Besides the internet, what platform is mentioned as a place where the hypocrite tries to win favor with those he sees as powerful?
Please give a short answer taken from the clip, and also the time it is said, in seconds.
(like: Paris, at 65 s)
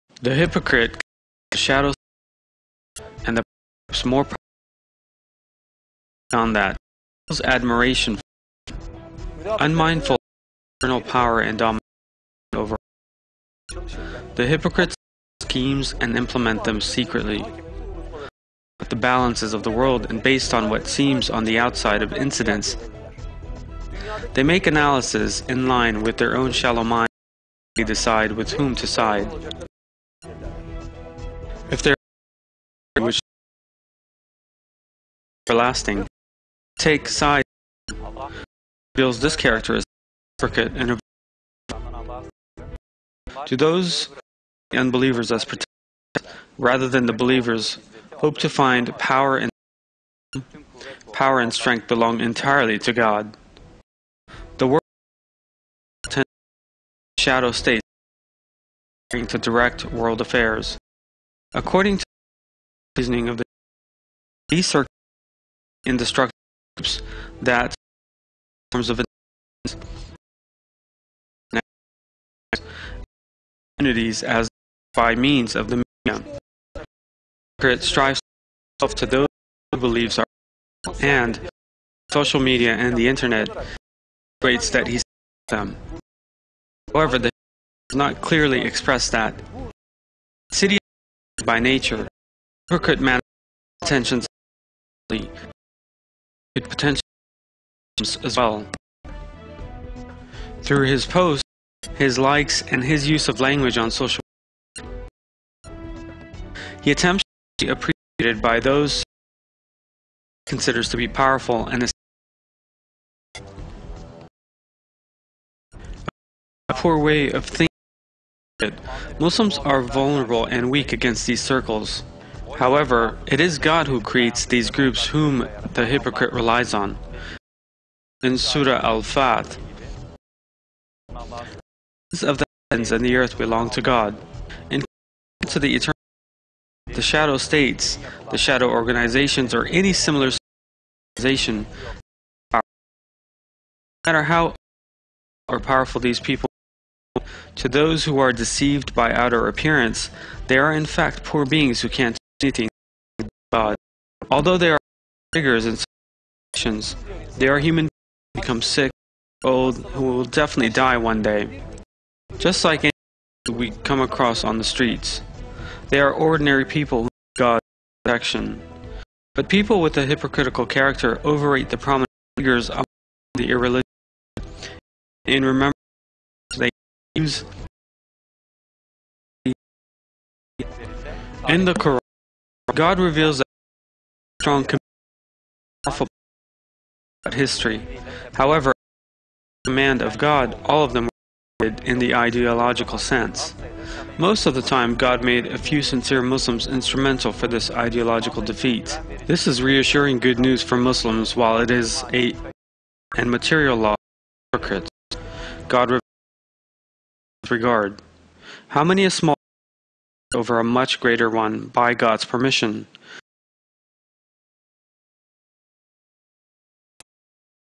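social media, at 82 s.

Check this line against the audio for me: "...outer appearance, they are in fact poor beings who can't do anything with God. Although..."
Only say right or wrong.
right.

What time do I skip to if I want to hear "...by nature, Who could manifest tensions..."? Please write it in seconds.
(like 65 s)
91 s.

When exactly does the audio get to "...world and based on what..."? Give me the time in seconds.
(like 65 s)
19 s.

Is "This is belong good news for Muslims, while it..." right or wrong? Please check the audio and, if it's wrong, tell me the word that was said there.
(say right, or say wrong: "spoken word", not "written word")
wrong: "reassuring", not "belong".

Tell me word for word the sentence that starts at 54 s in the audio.
The world shadow states to direct world affairs.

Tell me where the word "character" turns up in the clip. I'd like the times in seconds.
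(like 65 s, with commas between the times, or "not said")
39 s, 170 s.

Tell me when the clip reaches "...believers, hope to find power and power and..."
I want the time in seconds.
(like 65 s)
47 s.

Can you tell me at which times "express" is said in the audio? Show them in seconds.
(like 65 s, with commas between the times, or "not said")
88 s.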